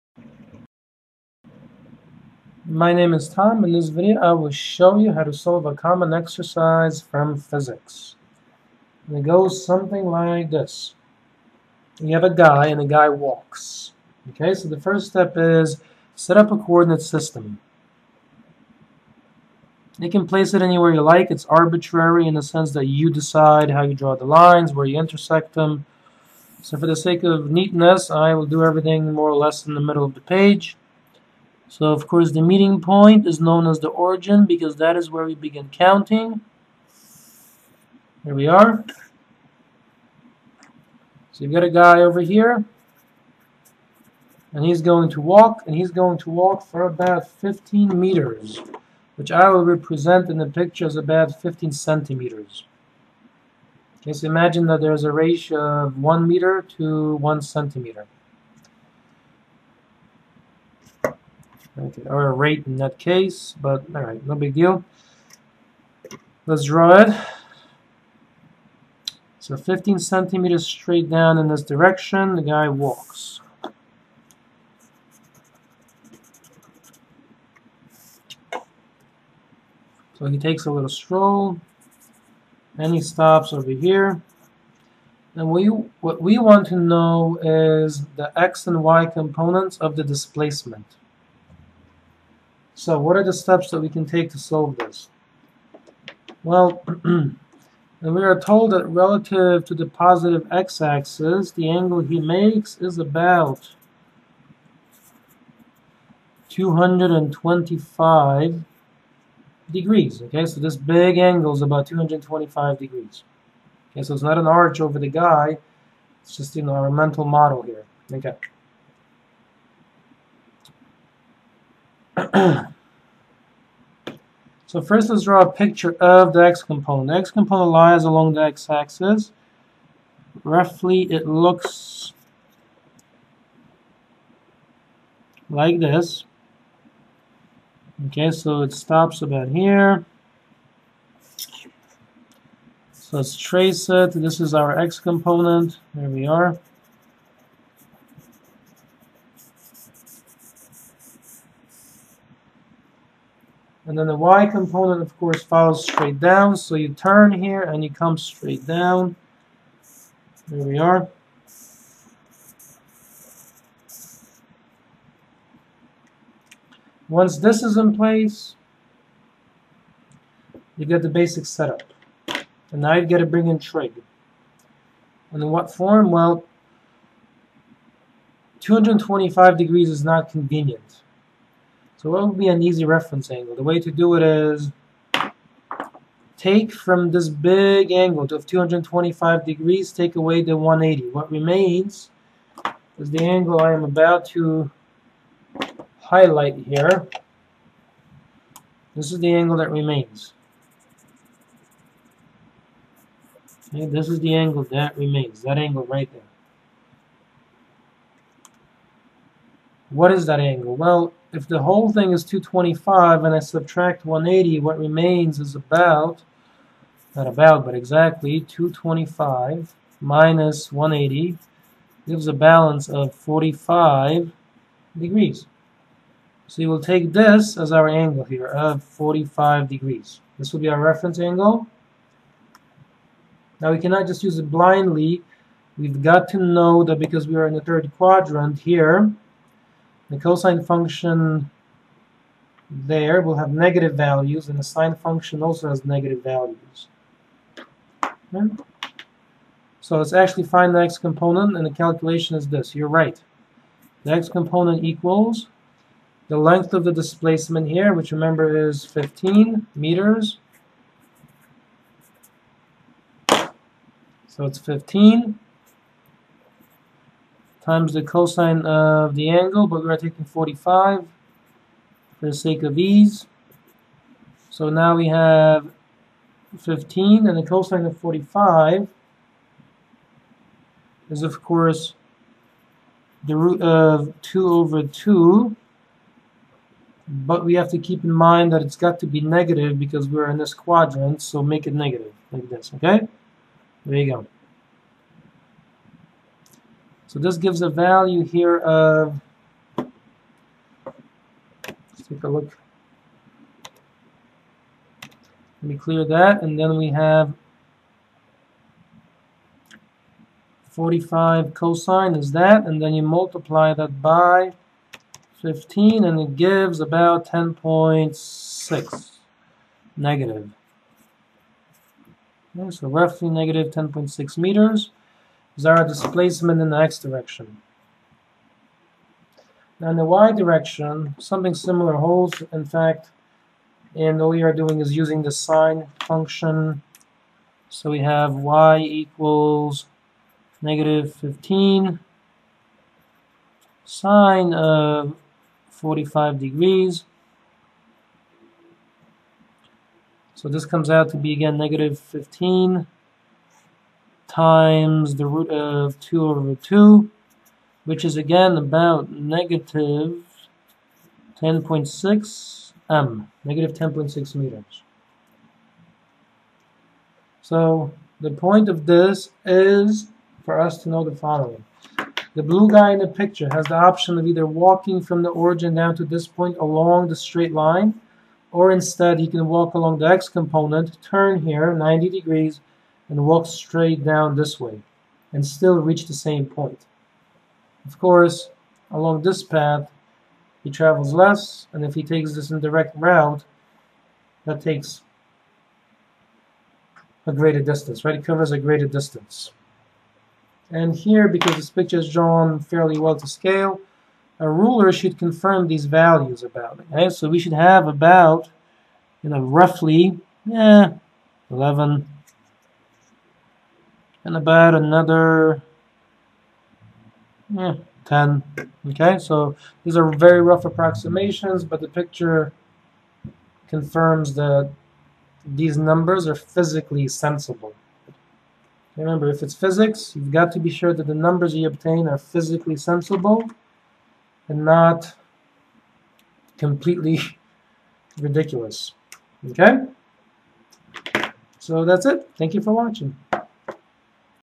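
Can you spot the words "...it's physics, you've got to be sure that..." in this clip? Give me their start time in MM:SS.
07:09.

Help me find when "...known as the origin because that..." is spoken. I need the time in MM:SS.
00:33.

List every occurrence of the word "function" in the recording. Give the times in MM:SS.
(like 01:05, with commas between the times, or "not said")
04:00, 04:04, 05:36.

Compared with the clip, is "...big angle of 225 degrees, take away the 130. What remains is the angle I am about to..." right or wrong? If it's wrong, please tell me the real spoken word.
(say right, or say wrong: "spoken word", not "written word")
wrong: "180", not "130".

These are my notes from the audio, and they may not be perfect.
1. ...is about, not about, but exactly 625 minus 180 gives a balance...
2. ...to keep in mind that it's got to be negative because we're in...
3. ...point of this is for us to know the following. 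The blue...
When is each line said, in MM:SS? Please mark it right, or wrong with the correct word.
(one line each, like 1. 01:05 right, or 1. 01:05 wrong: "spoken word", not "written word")
1. 03:35 wrong: "225", not "625"
2. 04:47 right
3. 06:08 right.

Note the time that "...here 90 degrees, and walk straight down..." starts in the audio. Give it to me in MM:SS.
06:21.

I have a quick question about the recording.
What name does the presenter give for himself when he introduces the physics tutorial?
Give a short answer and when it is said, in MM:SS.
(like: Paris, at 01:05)
Tom, at 00:03.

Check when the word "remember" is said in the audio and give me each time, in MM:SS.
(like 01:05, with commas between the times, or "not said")
04:18, 07:08.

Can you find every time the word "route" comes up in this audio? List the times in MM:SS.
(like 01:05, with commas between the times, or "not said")
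06:32.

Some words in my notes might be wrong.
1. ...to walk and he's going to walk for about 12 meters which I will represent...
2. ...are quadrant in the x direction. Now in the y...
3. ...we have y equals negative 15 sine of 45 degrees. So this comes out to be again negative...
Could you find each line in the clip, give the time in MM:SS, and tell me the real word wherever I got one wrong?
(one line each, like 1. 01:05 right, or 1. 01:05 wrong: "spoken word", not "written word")
1. 00:45 wrong: "15", not "12"
2. 05:25 wrong: "displacement", not "quadrant"
3. 05:37 right.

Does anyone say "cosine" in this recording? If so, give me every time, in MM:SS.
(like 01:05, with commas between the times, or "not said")
04:00, 04:28, 04:37, 05:11.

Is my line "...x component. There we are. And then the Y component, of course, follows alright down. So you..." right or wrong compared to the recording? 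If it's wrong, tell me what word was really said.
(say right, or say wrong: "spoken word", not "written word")
wrong: "straight", not "alright".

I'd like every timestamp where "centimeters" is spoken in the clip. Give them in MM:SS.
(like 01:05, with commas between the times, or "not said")
00:51, 00:57, 01:09.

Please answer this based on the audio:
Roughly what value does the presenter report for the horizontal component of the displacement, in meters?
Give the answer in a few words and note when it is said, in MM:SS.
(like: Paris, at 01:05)
-10.6, at 05:17.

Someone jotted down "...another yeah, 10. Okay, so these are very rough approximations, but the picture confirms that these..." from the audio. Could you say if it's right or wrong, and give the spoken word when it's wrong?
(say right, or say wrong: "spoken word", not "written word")
right.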